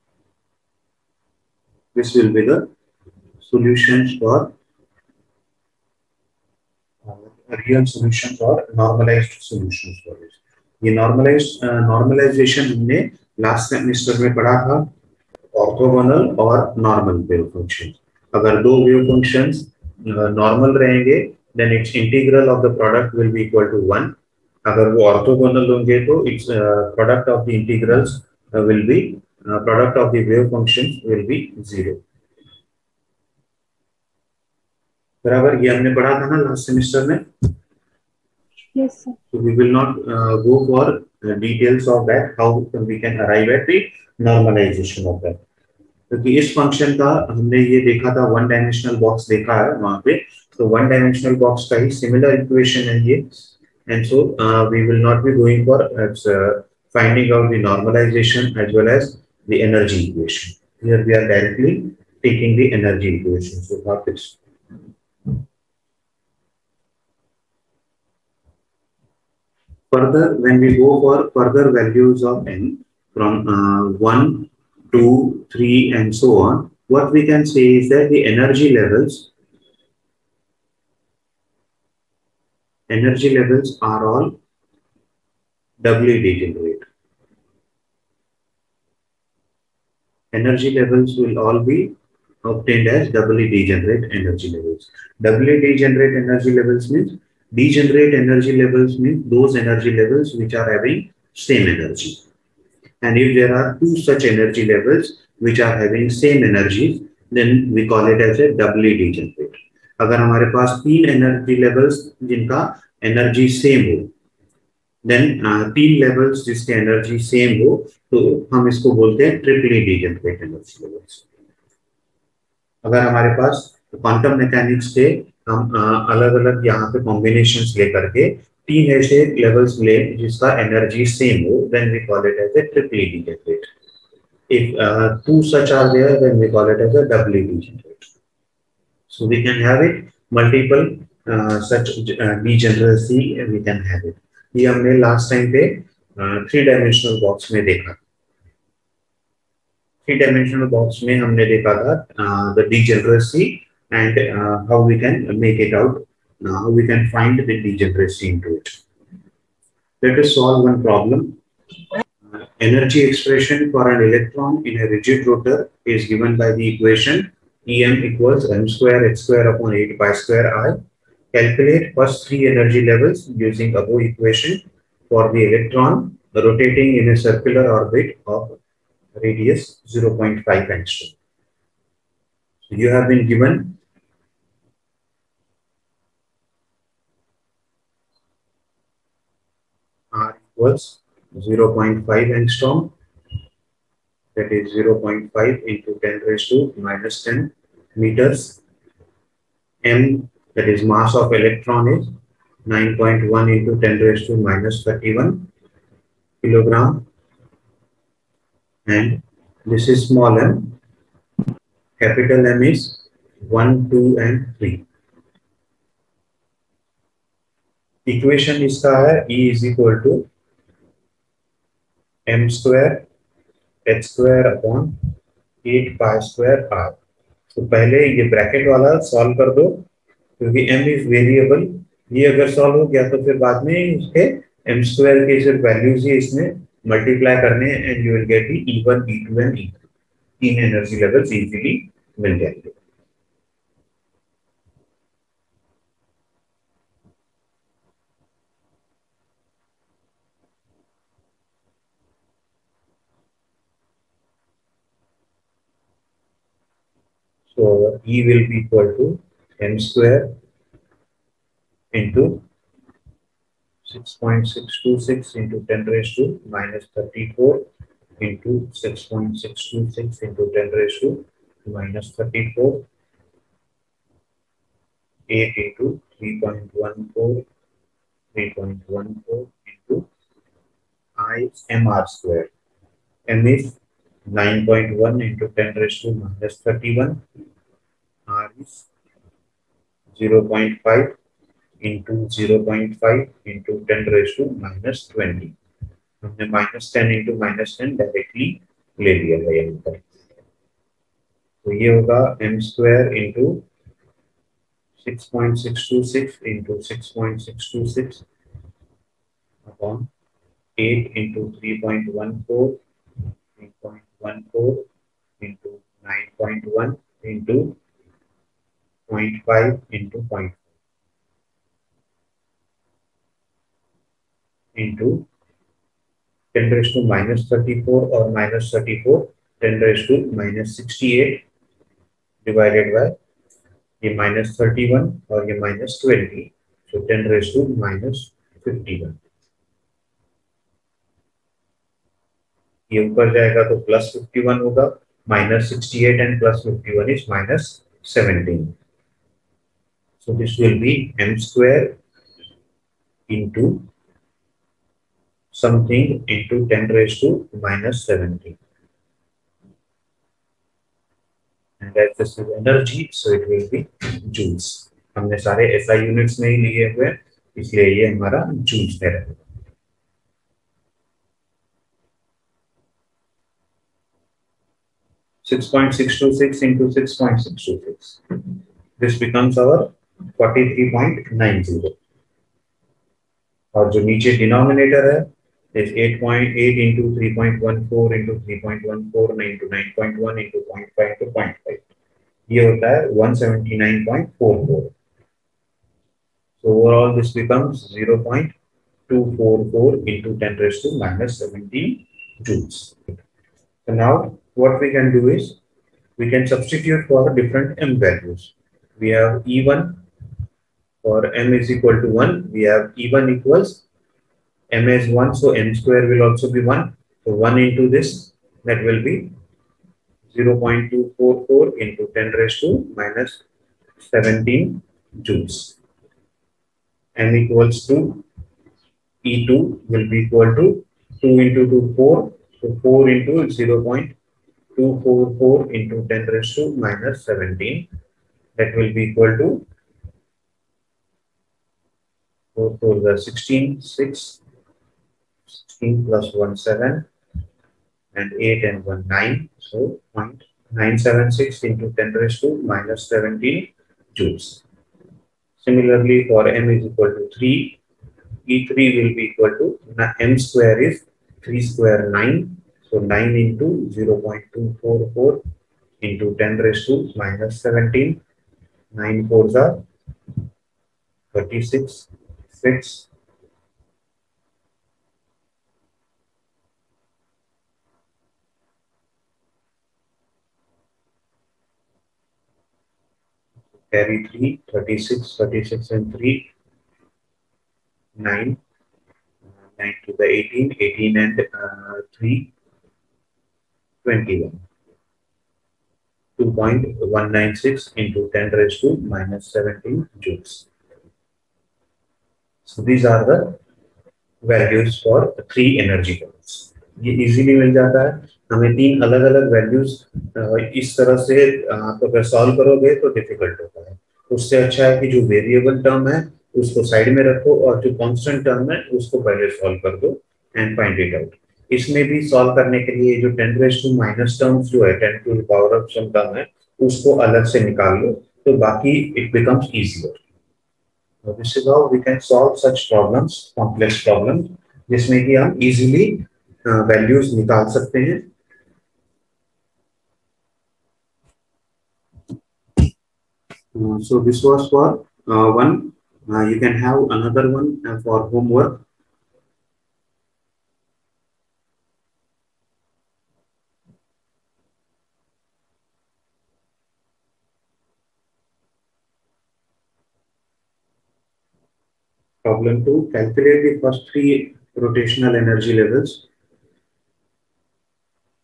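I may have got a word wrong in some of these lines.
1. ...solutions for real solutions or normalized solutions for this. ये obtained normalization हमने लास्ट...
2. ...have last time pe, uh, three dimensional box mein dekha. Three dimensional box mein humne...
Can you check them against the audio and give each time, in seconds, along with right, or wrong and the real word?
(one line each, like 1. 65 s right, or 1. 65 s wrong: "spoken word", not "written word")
1. 3 s wrong: "normalized", not "obtained"
2. 144 s right.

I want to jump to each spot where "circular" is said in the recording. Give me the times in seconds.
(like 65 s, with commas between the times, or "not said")
177 s.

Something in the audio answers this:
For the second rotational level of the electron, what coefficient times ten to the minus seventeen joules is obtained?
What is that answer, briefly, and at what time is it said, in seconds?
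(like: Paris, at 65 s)
0.976, at 450 s.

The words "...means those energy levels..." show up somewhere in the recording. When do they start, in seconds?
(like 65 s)
98 s.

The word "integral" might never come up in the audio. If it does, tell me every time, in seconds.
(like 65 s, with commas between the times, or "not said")
21 s, 27 s.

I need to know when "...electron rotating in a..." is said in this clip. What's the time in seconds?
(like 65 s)
175 s.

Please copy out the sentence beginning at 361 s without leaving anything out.
And that this is energy, so it will be joules.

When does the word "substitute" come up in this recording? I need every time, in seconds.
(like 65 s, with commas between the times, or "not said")
406 s.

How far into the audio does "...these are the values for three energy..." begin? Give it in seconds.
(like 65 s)
502 s.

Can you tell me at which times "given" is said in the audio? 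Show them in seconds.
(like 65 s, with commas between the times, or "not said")
166 s, 183 s.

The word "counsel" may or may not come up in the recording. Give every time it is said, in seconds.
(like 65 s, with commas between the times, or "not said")
not said.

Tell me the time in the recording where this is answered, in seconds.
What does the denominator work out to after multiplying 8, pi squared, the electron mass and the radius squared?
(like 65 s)
393 s.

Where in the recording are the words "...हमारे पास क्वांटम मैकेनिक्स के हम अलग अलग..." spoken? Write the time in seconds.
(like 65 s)
123 s.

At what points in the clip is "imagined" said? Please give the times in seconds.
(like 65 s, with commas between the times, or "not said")
not said.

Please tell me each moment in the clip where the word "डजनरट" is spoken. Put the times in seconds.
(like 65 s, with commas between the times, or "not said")
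119 s, 133 s.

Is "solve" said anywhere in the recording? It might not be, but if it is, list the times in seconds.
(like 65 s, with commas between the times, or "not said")
160 s.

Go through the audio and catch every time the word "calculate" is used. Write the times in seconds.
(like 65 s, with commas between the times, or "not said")
171 s, 563 s.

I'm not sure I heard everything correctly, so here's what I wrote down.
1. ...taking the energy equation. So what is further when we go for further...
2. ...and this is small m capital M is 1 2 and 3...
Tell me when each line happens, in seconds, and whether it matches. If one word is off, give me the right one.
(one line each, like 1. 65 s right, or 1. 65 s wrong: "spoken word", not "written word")
1. 62 s right
2. 208 s right.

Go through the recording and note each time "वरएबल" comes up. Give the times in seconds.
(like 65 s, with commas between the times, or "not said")
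231 s, 515 s.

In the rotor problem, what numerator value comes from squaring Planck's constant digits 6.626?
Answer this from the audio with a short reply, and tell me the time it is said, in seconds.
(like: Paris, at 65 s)
43.90, at 380 s.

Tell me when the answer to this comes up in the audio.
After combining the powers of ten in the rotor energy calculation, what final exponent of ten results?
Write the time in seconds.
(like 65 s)
347 s.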